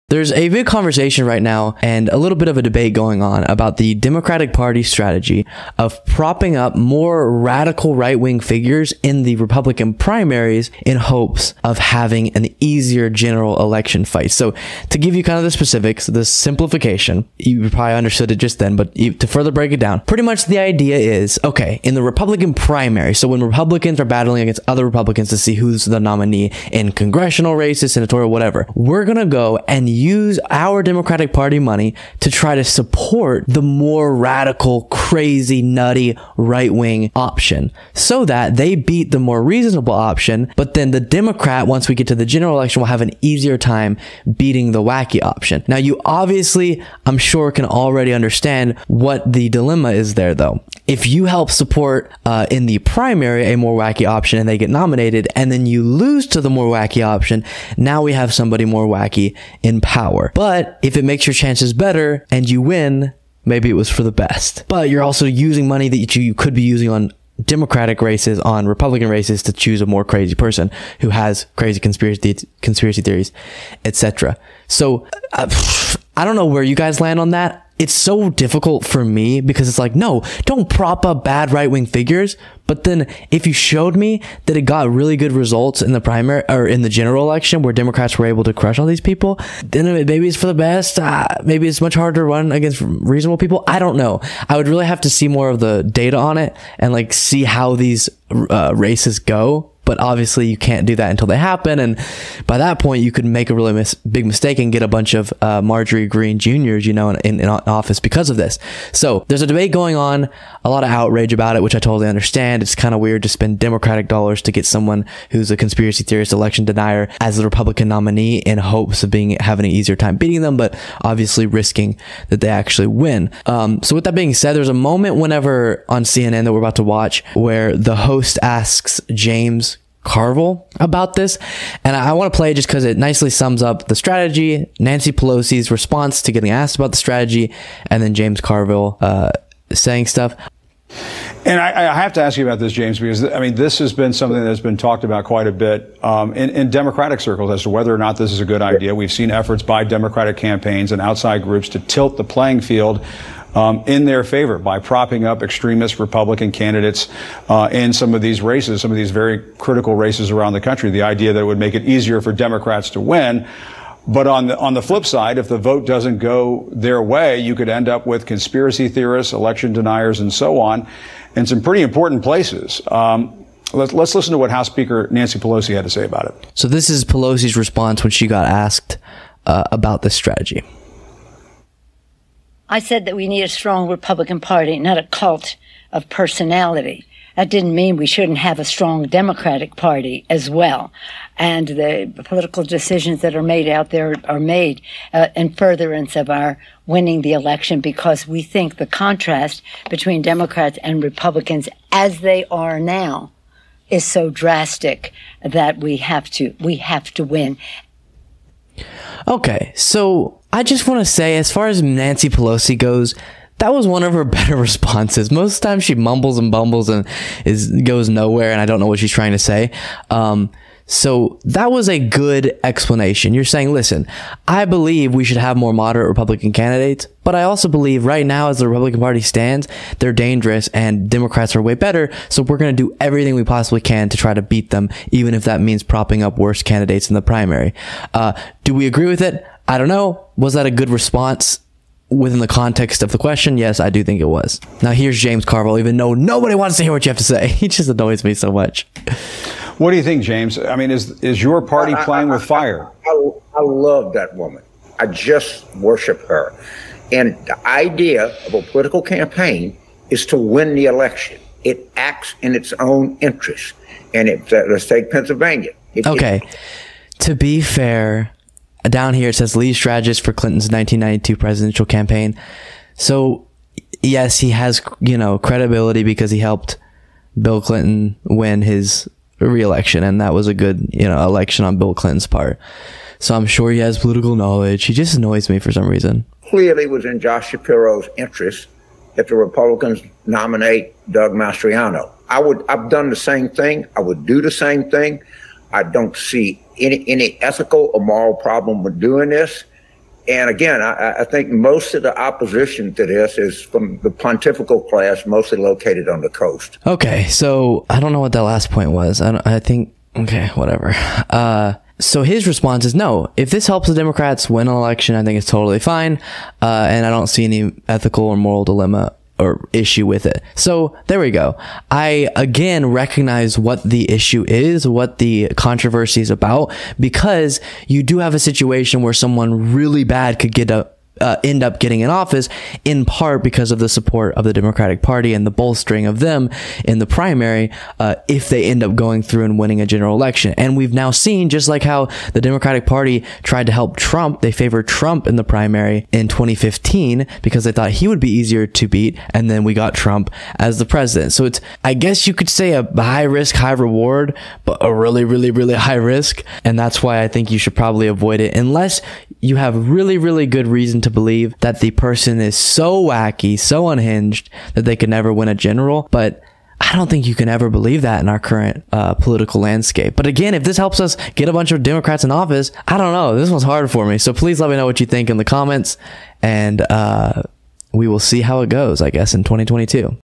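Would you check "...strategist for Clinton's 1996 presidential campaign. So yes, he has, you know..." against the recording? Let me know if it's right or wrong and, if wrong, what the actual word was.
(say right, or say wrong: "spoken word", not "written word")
wrong: "1992", not "1996".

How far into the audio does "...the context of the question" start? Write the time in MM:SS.
04:02.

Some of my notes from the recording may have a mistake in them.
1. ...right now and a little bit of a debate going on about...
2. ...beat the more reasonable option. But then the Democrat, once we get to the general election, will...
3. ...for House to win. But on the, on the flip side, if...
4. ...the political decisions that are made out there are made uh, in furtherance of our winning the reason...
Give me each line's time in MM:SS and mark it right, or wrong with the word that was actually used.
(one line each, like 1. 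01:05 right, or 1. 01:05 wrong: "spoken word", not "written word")
1. 00:01 right
2. 00:38 right
3. 02:42 wrong: "Democrats", not "House"
4. 03:11 wrong: "election", not "reason".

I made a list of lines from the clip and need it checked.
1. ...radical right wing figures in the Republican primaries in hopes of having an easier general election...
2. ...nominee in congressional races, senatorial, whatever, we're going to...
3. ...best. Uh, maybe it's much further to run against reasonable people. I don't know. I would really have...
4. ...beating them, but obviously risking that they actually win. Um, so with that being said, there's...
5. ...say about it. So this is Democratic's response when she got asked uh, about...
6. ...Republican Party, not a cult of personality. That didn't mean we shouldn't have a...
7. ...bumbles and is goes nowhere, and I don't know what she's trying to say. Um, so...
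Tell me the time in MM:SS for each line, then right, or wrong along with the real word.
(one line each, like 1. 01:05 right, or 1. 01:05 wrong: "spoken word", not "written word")
1. 00:07 right
2. 00:26 right
3. 01:30 wrong: "harder", not "further"
4. 02:00 right
5. 02:55 wrong: "Pelosi", not "Democratic"
6. 03:03 right
7. 03:36 right.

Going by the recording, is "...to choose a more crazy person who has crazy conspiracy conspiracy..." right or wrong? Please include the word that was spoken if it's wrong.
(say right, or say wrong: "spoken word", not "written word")
right.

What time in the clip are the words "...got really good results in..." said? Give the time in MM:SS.
01:24.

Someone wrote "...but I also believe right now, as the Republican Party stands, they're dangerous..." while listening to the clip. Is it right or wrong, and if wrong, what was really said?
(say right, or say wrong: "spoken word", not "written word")
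right.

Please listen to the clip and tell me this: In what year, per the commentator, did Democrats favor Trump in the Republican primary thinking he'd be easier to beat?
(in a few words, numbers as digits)
2015.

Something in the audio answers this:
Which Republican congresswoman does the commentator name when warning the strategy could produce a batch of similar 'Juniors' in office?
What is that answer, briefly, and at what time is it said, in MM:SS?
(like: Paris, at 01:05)
Marjorie Greene, at 01:45.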